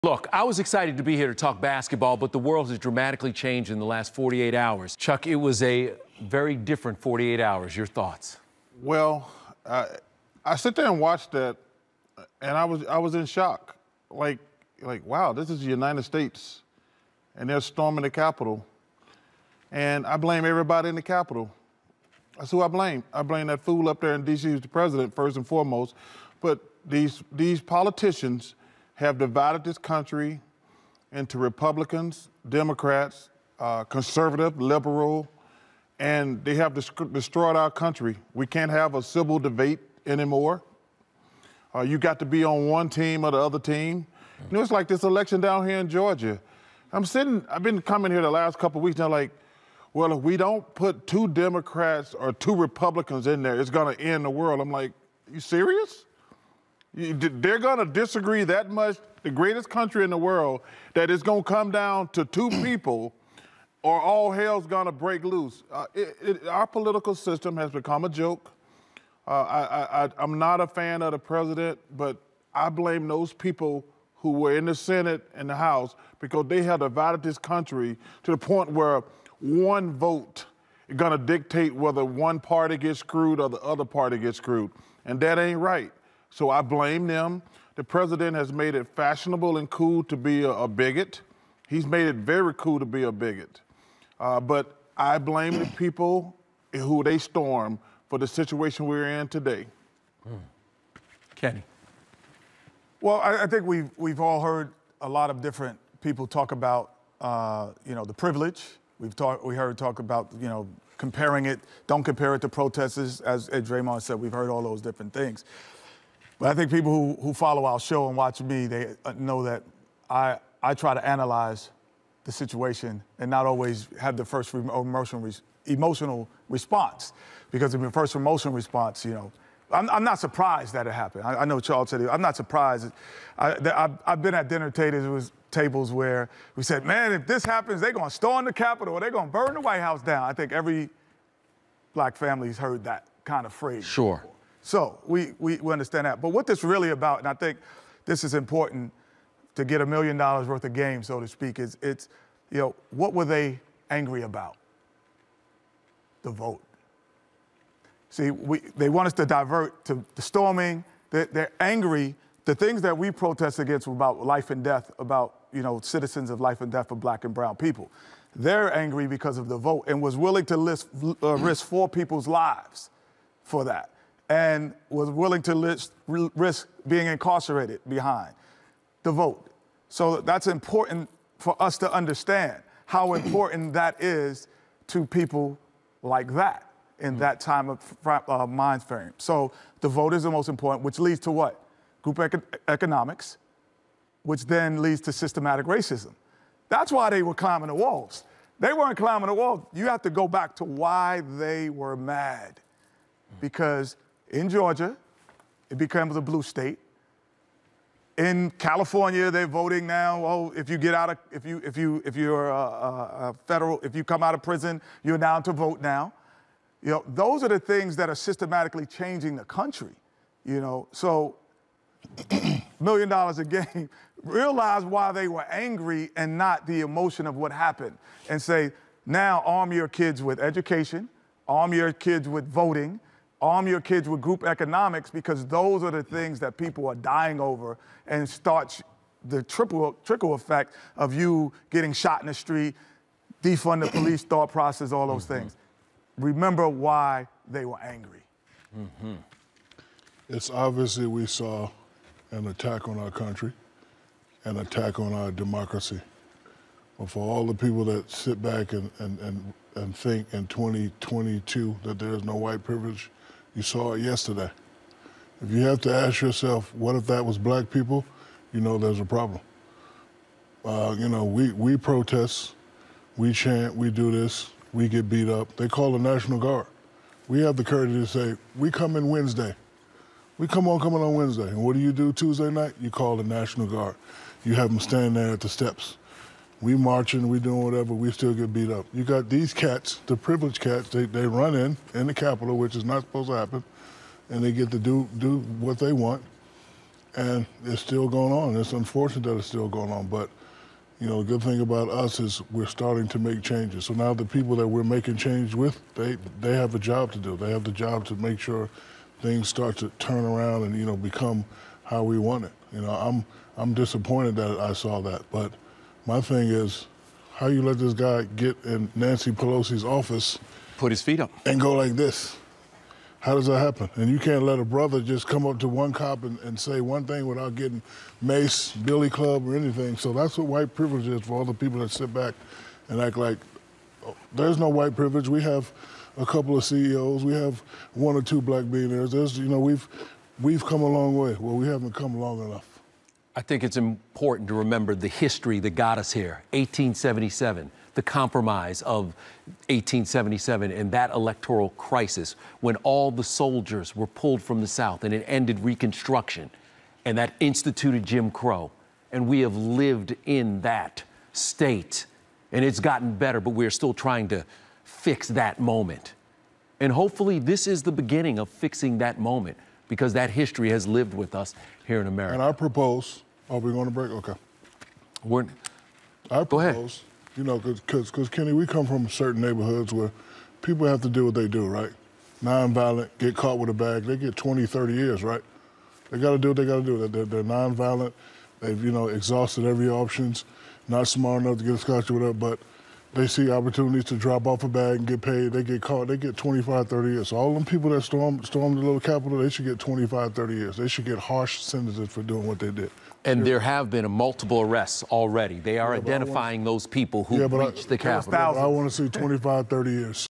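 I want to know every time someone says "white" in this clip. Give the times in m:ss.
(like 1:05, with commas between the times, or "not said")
2:19, 4:22, 5:30, 5:34.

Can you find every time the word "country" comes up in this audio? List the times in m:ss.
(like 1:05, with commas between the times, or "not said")
0:29, 0:37, 0:59, 1:17, 3:39, 4:13.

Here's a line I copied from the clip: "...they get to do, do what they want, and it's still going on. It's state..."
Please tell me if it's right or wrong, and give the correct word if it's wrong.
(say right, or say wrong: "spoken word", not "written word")
wrong: "unfortunate", not "state".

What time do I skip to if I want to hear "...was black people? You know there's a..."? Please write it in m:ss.
4:27.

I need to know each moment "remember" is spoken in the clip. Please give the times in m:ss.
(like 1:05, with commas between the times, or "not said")
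4:06, 5:44.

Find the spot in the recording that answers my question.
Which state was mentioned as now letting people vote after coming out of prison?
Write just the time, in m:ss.
3:28.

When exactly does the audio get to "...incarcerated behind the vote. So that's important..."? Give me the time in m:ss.
2:57.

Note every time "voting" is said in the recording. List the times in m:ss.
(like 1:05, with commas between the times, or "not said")
3:29, 3:52.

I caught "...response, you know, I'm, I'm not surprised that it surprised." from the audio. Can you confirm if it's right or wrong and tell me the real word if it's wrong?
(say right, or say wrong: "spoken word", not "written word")
wrong: "happened", not "surprised".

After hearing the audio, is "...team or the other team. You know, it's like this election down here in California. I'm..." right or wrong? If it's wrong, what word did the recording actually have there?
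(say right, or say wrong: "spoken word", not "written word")
wrong: "Georgia", not "California".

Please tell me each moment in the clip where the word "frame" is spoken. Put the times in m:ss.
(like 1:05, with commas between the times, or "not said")
3:08.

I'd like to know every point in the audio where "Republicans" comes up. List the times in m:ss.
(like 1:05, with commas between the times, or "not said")
0:31, 0:52.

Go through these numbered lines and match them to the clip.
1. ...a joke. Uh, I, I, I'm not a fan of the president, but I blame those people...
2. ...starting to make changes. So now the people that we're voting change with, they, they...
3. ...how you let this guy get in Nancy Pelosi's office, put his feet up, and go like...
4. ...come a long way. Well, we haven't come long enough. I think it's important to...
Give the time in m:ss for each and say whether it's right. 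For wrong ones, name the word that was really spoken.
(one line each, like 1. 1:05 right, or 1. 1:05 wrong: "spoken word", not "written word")
1. 1:08 right
2. 5:02 wrong: "making", not "voting"
3. 5:17 right
4. 5:40 right.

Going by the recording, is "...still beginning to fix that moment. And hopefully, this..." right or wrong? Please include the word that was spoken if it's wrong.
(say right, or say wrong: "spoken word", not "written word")
wrong: "trying", not "beginning".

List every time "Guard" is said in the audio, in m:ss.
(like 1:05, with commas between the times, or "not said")
4:36, 4:43.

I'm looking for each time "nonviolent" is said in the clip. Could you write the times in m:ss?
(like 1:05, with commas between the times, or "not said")
6:22, 6:27.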